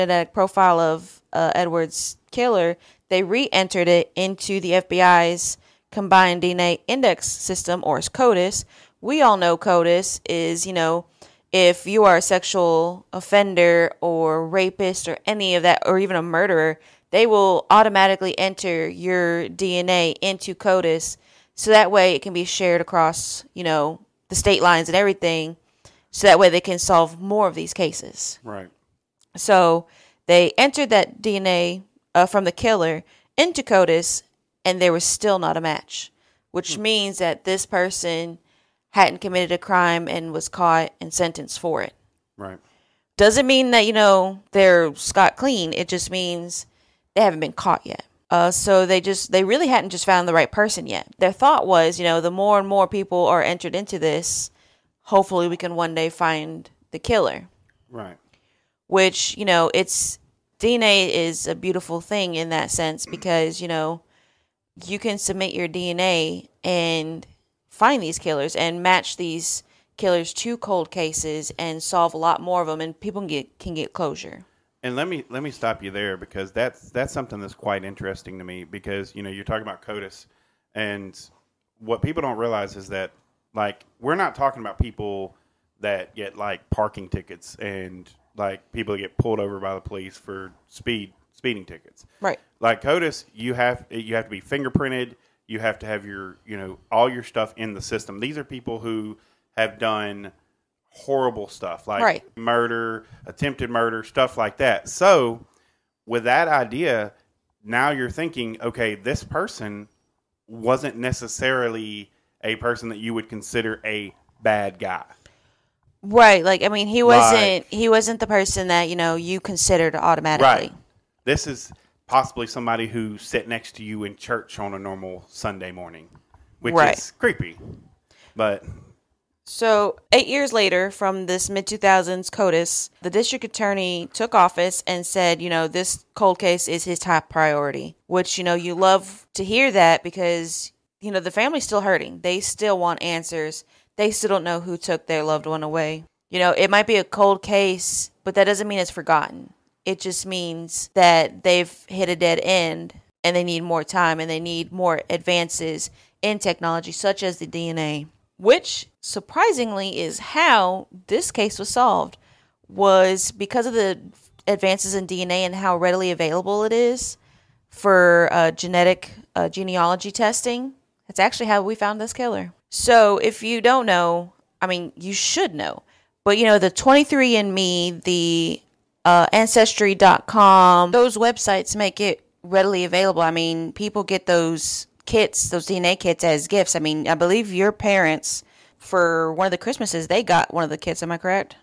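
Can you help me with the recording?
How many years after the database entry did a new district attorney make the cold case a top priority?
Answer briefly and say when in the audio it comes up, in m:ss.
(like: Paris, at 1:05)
8, at 2:10.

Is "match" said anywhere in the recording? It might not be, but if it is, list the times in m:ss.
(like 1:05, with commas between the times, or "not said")
0:35, 1:08.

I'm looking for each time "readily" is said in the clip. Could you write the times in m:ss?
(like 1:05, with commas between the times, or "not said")
2:45, 3:02.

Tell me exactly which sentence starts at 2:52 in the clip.
So if you don't know, I mean, you should know.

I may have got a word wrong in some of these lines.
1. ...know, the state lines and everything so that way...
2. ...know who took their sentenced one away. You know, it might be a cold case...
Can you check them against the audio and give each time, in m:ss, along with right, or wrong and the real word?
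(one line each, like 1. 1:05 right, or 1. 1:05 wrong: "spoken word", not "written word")
1. 0:23 right
2. 2:24 wrong: "loved", not "sentenced".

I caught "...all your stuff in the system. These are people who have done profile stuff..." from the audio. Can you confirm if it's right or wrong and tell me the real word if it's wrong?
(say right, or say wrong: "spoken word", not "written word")
wrong: "horrible", not "profile".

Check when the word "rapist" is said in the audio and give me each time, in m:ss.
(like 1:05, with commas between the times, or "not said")
0:14.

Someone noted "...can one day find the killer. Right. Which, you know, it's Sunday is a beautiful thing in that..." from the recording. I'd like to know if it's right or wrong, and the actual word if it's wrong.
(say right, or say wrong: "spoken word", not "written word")
wrong: "DNA", not "Sunday".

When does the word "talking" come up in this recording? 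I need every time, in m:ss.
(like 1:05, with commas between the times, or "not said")
1:19, 1:24.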